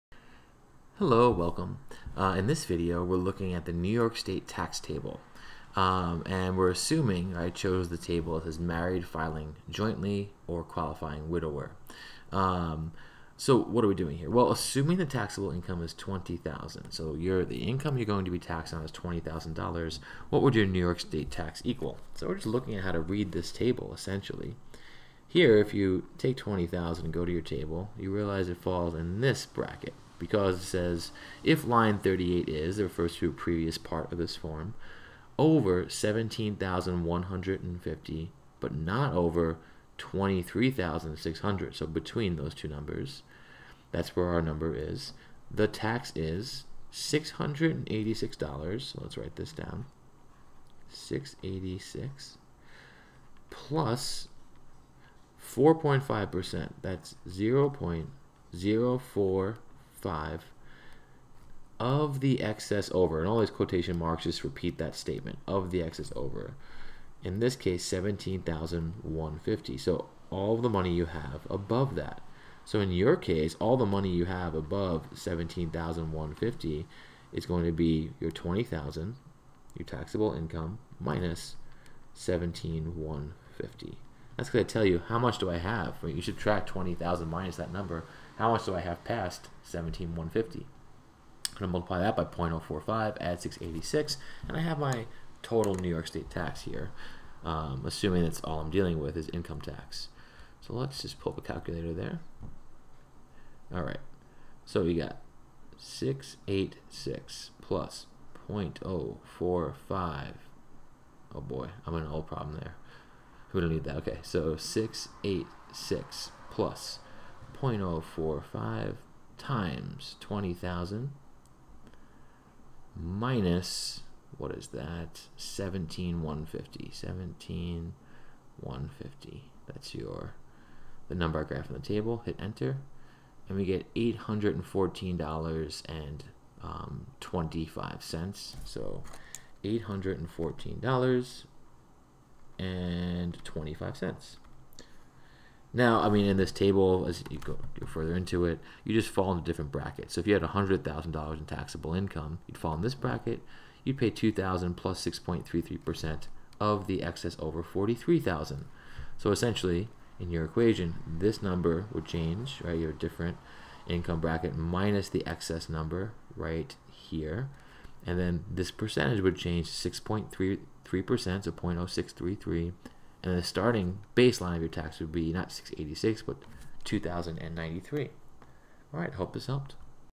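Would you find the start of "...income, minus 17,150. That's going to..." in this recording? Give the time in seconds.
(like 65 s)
80 s.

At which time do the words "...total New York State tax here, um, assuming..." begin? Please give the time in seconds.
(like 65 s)
95 s.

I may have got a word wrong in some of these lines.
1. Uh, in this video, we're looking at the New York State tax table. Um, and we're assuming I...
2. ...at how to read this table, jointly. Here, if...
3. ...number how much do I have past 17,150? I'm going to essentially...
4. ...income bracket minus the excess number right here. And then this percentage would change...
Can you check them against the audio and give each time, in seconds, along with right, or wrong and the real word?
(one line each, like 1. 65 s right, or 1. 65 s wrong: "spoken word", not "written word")
1. 2 s right
2. 22 s wrong: "essentially", not "jointly"
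3. 87 s wrong: "multiply", not "essentially"
4. 163 s right.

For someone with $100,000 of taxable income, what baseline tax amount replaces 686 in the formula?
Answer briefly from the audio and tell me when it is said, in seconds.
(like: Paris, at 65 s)
2093, at 176 s.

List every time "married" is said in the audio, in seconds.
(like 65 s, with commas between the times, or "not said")
8 s.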